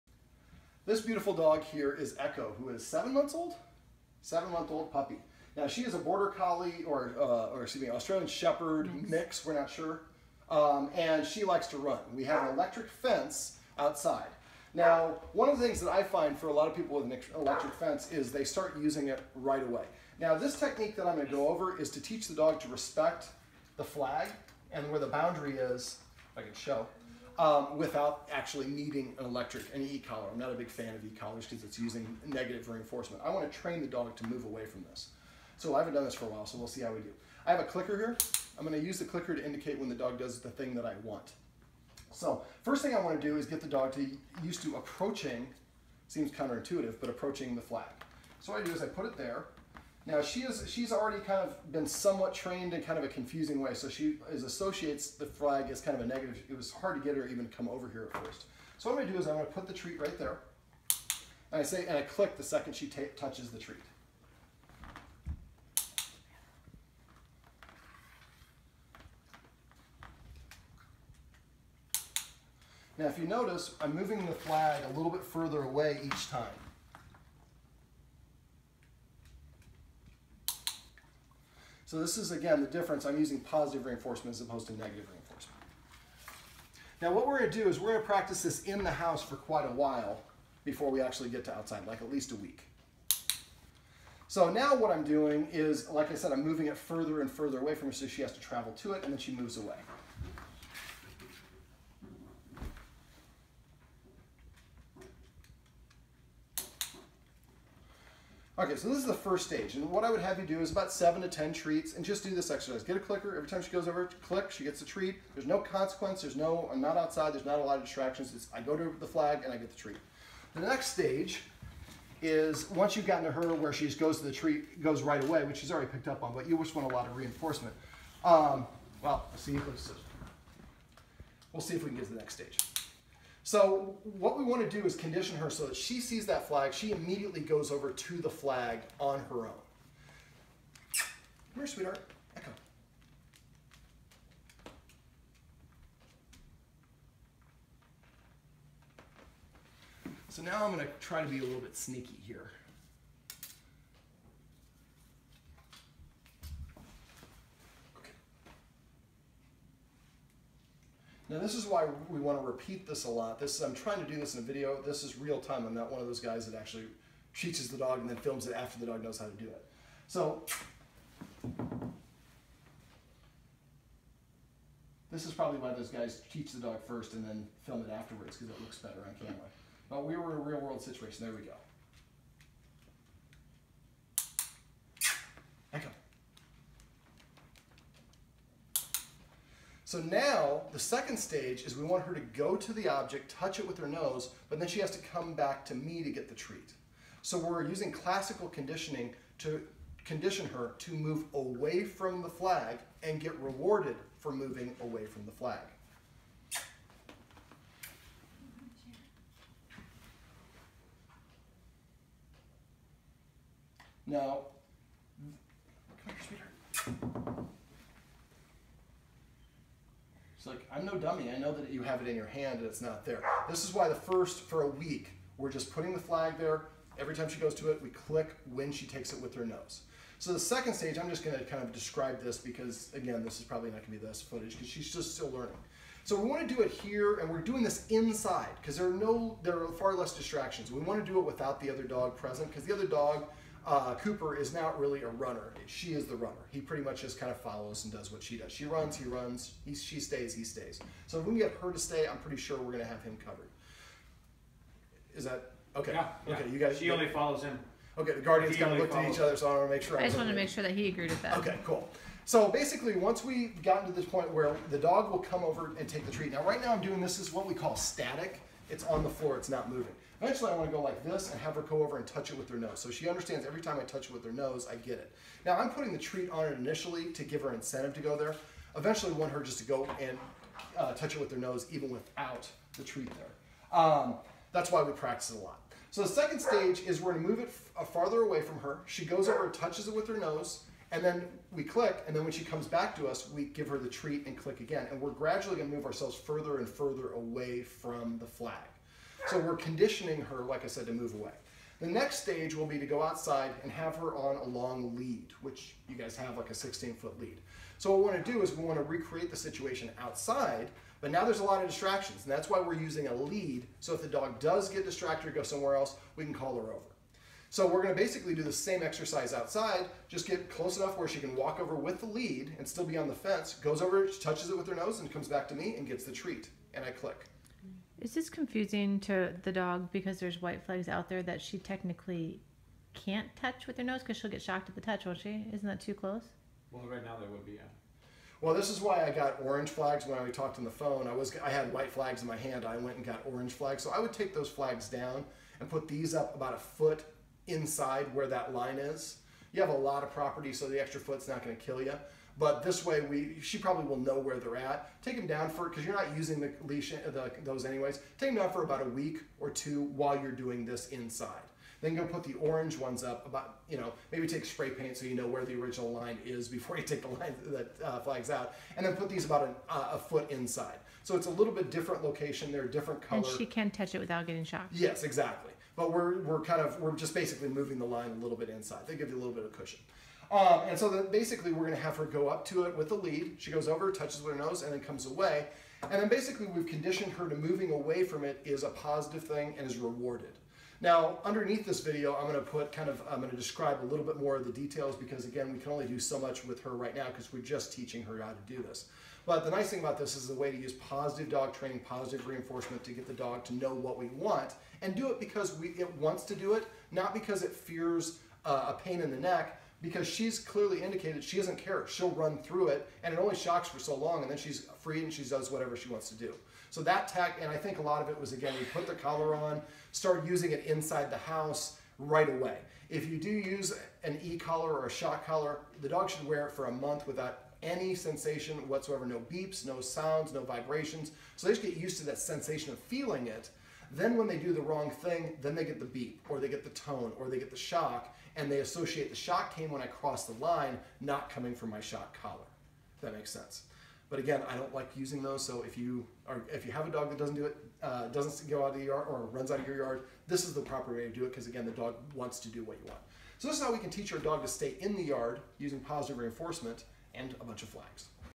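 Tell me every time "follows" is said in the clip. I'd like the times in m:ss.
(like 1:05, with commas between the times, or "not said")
4:07, 4:17.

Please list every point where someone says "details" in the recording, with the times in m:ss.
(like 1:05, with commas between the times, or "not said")
6:34.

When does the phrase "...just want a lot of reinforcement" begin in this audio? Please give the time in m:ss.
2:06.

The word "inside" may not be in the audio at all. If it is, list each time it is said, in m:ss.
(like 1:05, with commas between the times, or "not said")
3:57, 5:47, 6:00, 6:10, 6:18, 7:00.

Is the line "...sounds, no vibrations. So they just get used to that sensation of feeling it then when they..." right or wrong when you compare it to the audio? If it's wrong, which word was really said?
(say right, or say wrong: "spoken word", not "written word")
right.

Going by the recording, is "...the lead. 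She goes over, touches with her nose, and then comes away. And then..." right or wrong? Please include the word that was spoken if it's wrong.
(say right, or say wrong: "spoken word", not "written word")
right.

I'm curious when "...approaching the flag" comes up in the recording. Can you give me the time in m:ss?
0:47.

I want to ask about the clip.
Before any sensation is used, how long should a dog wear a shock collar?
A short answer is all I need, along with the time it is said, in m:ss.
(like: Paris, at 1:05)
A month, at 7:06.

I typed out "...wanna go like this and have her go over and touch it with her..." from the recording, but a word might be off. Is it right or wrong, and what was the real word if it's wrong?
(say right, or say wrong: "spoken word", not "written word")
right.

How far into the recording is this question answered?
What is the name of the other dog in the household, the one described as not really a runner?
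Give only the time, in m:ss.
4:03.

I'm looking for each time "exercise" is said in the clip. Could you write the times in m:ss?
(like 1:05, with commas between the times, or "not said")
1:52, 5:18.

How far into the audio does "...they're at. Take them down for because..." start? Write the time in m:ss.
5:54.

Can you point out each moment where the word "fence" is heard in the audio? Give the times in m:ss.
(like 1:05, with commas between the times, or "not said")
0:12, 0:17, 5:23.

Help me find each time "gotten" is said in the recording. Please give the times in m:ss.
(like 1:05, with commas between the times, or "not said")
2:03, 4:23.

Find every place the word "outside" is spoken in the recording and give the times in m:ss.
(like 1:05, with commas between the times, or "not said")
0:13, 1:31, 1:56, 5:03, 5:09, 5:19.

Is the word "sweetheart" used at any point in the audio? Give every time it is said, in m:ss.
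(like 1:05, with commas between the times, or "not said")
2:21, 3:36.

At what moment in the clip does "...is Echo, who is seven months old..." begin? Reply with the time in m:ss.
0:01.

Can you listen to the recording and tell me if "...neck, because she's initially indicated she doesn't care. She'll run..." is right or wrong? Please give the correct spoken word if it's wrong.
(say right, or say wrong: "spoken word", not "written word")
wrong: "clearly", not "initially".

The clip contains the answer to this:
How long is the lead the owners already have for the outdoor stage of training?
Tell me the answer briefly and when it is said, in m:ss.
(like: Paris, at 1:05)
16 feet, at 5:06.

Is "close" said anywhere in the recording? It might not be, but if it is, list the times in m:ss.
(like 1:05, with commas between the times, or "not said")
5:20, 5:35.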